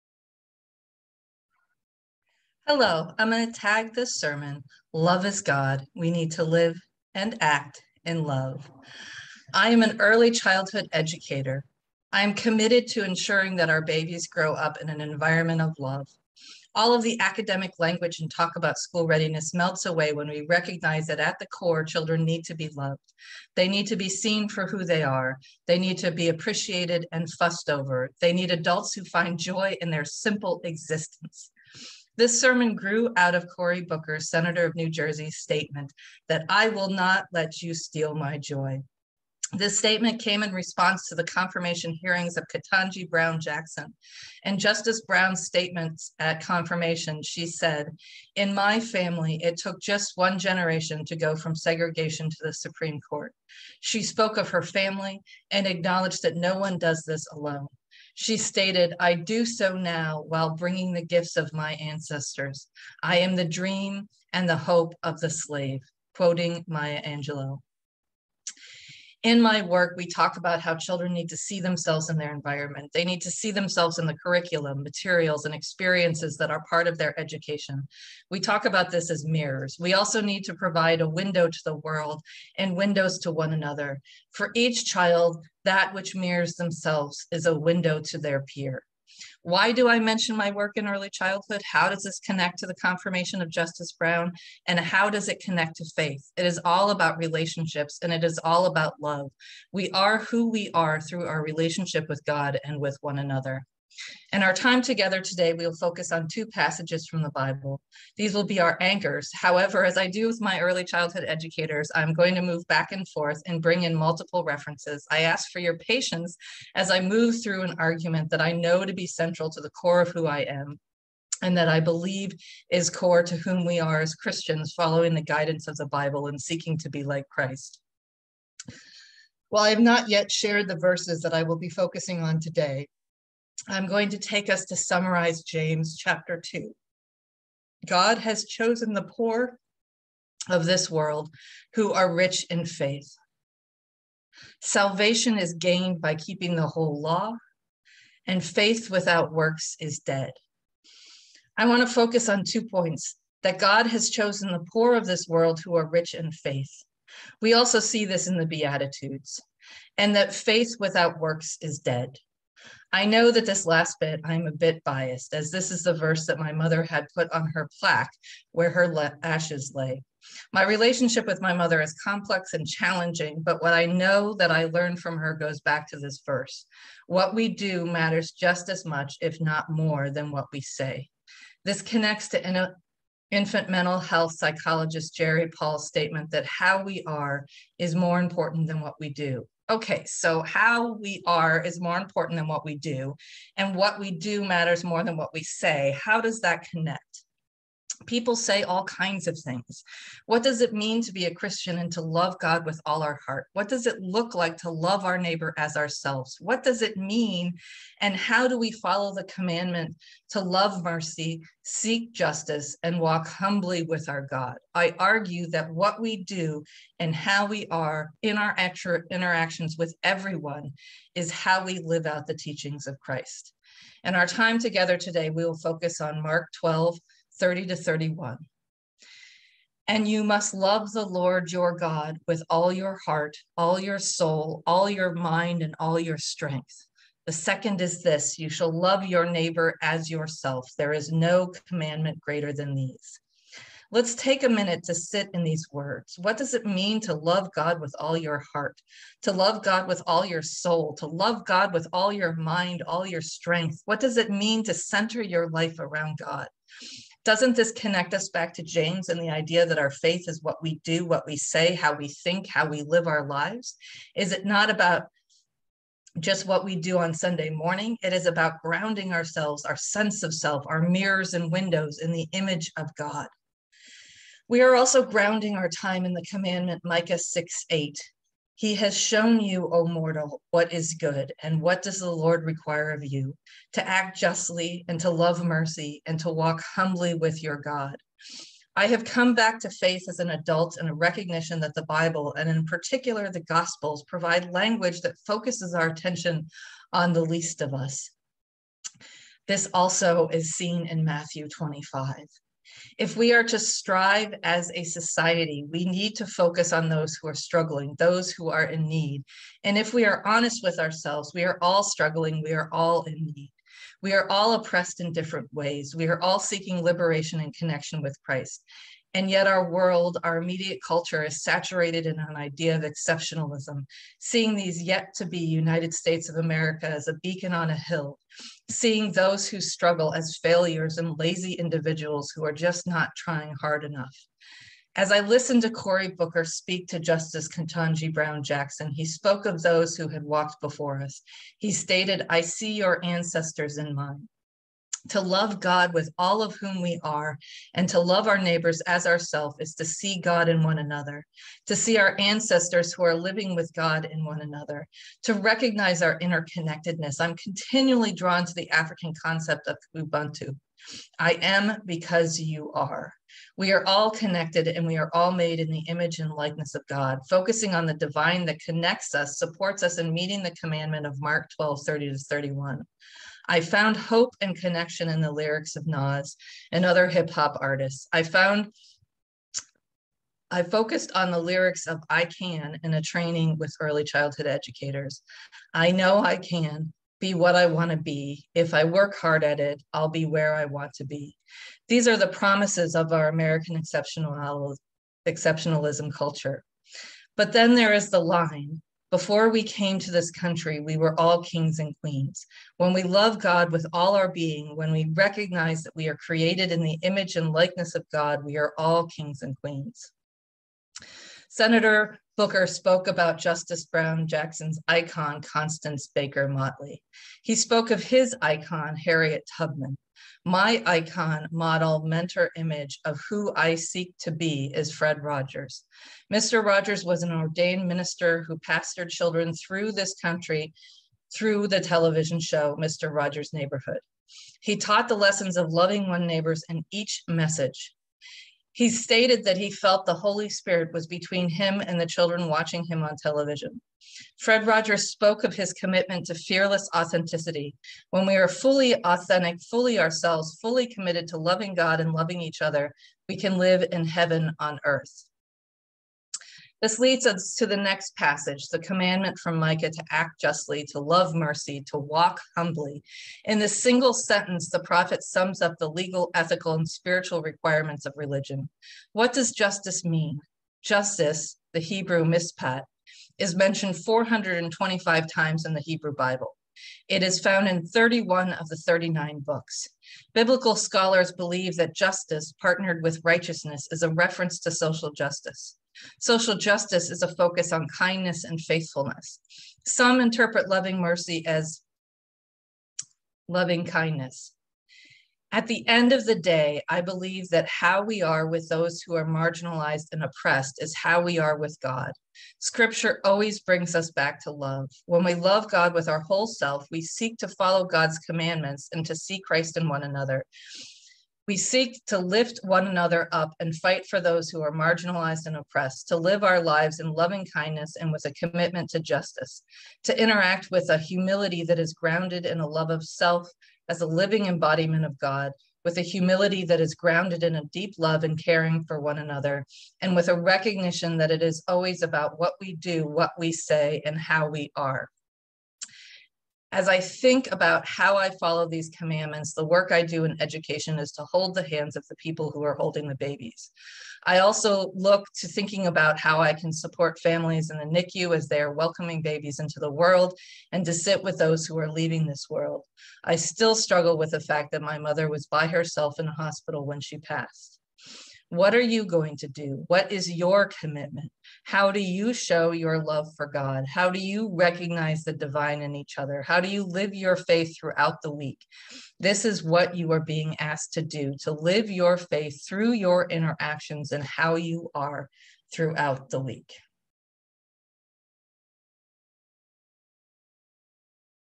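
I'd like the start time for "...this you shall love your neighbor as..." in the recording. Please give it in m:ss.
3:58.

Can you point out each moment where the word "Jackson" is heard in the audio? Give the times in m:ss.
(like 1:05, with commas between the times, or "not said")
0:43, 5:38, 6:54.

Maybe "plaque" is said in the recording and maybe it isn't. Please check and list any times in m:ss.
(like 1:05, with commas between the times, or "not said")
2:47.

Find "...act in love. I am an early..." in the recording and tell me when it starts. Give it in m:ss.
0:07.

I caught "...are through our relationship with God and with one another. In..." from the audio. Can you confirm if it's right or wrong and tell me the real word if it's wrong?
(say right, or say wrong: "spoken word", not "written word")
right.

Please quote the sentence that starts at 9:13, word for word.
I still struggle with the fact that my mother was by herself in a hospital when she passed.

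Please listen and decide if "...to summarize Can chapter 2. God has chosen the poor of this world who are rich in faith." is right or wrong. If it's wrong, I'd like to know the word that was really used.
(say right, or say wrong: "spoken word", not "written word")
wrong: "James", not "Can".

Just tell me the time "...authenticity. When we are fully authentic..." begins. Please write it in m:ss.
7:26.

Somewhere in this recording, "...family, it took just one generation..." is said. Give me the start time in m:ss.
0:48.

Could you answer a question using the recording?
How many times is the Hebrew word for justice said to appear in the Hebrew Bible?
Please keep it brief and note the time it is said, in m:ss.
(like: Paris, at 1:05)
425, at 7:54.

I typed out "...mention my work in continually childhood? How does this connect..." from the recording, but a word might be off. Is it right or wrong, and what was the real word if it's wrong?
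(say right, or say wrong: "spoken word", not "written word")
wrong: "early", not "continually".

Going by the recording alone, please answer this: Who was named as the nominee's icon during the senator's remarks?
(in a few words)
Constance Baker Motley.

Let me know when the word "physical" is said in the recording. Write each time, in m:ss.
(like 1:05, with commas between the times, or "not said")
not said.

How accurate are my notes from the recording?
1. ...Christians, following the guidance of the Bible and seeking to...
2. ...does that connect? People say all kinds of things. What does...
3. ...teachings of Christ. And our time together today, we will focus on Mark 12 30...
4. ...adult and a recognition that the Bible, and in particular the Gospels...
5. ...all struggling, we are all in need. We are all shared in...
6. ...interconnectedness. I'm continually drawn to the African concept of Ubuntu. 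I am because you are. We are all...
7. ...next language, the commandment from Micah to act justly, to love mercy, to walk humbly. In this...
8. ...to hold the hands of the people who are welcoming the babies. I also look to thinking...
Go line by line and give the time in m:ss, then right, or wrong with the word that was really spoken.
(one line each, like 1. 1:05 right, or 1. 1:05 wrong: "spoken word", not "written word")
1. 2:04 right
2. 3:16 right
3. 3:42 right
4. 4:50 right
5. 5:11 wrong: "oppressed", not "shared"
6. 5:56 right
7. 7:37 wrong: "passage", not "language"
8. 9:01 wrong: "holding", not "welcoming".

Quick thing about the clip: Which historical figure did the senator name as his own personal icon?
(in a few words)
Harriet Tubman.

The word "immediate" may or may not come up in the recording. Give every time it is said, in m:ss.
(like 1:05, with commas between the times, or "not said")
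5:20.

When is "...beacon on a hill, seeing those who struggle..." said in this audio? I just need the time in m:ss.
5:27.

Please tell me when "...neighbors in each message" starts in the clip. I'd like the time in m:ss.
7:16.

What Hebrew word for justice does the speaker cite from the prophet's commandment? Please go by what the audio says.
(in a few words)
mispat.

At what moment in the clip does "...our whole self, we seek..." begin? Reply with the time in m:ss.
8:26.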